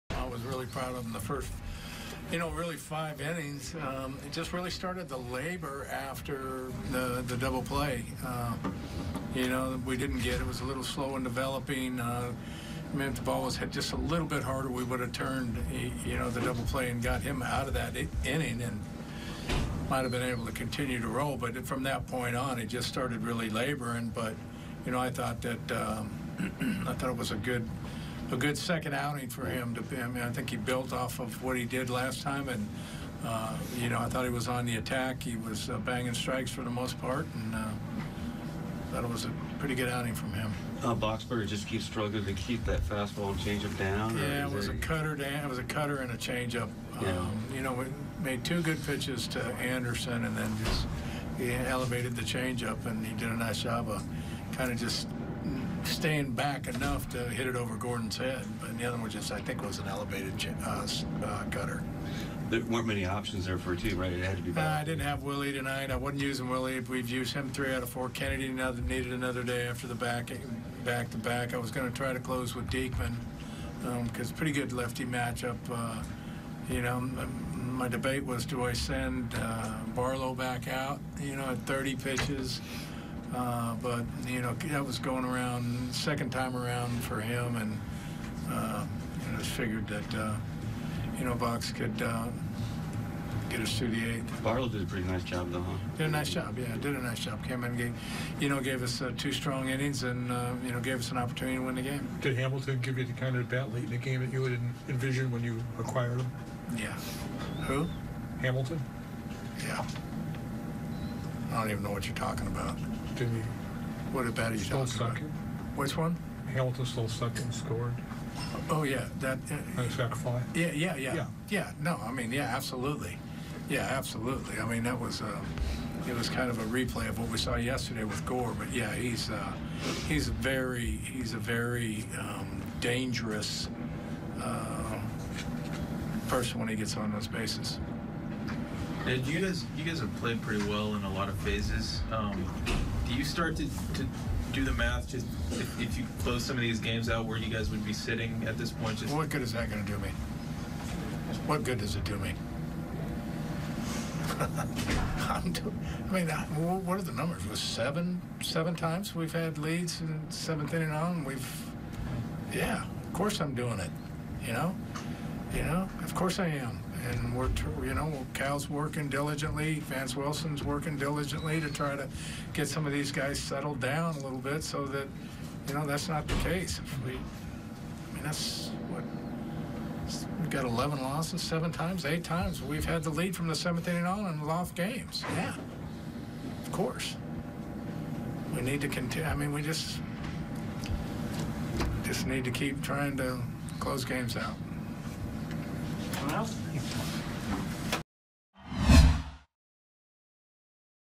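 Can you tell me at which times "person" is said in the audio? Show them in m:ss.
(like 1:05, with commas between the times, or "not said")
2:16.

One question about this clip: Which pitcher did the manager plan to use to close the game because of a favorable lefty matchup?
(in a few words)
Diekman.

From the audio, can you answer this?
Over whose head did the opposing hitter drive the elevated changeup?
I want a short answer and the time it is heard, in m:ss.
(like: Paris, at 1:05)
Gordon, at 0:57.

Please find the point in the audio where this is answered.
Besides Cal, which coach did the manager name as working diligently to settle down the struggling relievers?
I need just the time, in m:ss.
2:49.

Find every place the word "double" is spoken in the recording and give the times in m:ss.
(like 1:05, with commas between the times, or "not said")
0:07, 0:16.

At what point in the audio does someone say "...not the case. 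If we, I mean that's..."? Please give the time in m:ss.
2:56.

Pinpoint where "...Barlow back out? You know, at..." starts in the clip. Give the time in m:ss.
1:19.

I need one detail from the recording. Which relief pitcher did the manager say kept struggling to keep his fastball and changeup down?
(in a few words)
Boxberger.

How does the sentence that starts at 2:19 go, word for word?
And you guys, you guys have played pretty well in a lot of phases.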